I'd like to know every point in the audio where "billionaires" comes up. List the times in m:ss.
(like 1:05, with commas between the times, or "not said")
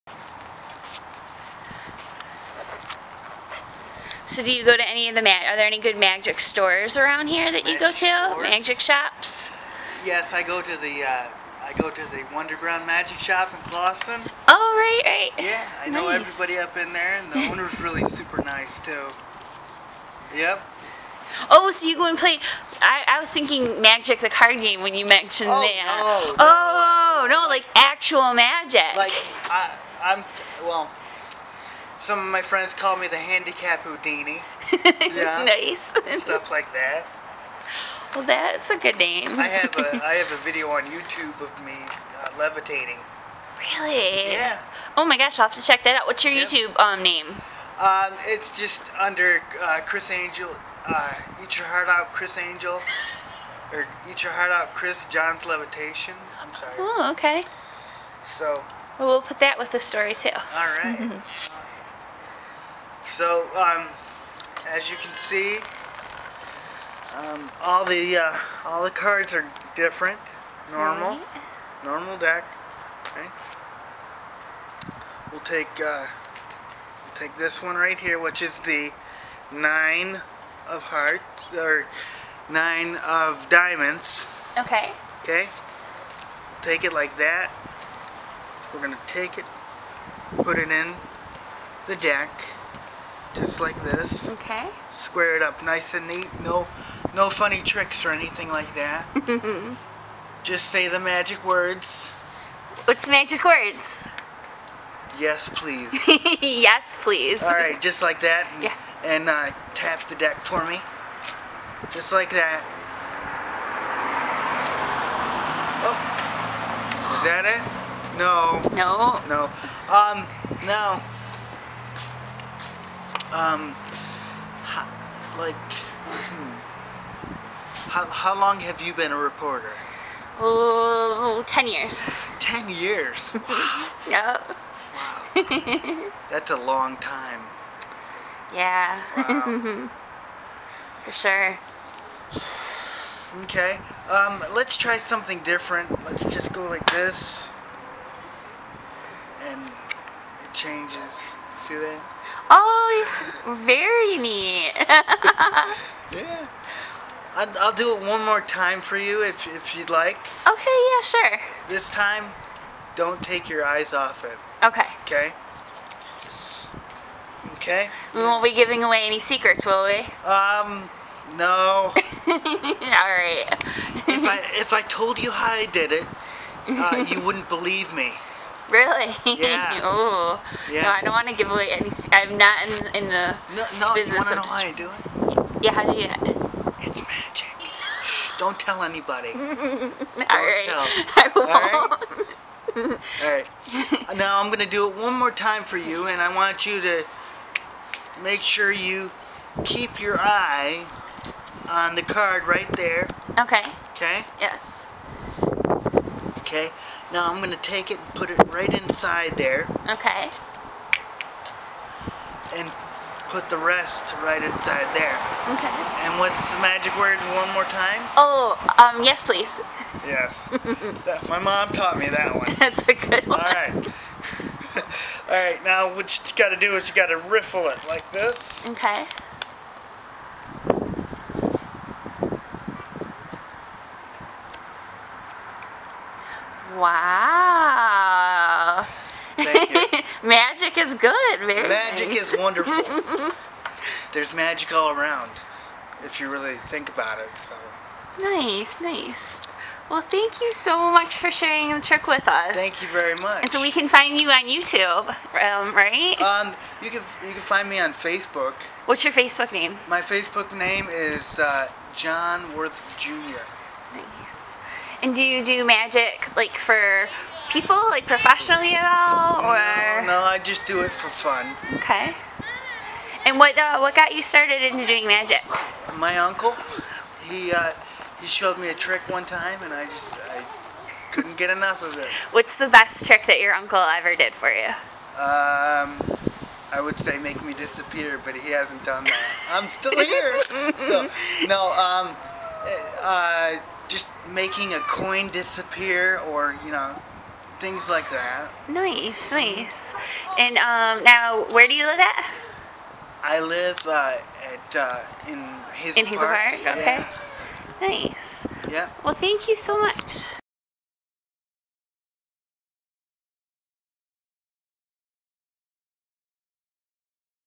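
not said.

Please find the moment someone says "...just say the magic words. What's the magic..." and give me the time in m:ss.
1:40.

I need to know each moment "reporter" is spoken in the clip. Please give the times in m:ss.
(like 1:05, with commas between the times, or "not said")
2:09.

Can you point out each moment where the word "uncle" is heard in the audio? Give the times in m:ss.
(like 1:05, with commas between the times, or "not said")
4:36, 4:43.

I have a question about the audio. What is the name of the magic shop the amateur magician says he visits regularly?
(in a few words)
Wonderground Magic Shop.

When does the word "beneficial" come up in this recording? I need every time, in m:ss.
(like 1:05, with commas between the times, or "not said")
not said.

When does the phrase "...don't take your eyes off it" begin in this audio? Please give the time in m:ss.
2:42.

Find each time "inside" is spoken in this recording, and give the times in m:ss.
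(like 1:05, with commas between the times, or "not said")
3:28, 3:34.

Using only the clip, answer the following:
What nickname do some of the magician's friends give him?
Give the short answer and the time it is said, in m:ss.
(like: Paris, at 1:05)
Handicap Houdini, at 0:33.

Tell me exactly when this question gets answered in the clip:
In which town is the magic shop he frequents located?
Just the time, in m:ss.
0:13.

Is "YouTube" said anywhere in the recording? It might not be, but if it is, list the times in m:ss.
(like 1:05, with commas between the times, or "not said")
0:40, 0:46, 4:14.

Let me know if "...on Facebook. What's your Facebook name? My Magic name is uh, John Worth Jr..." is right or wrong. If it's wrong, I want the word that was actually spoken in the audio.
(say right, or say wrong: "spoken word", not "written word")
wrong: "Facebook", not "Magic".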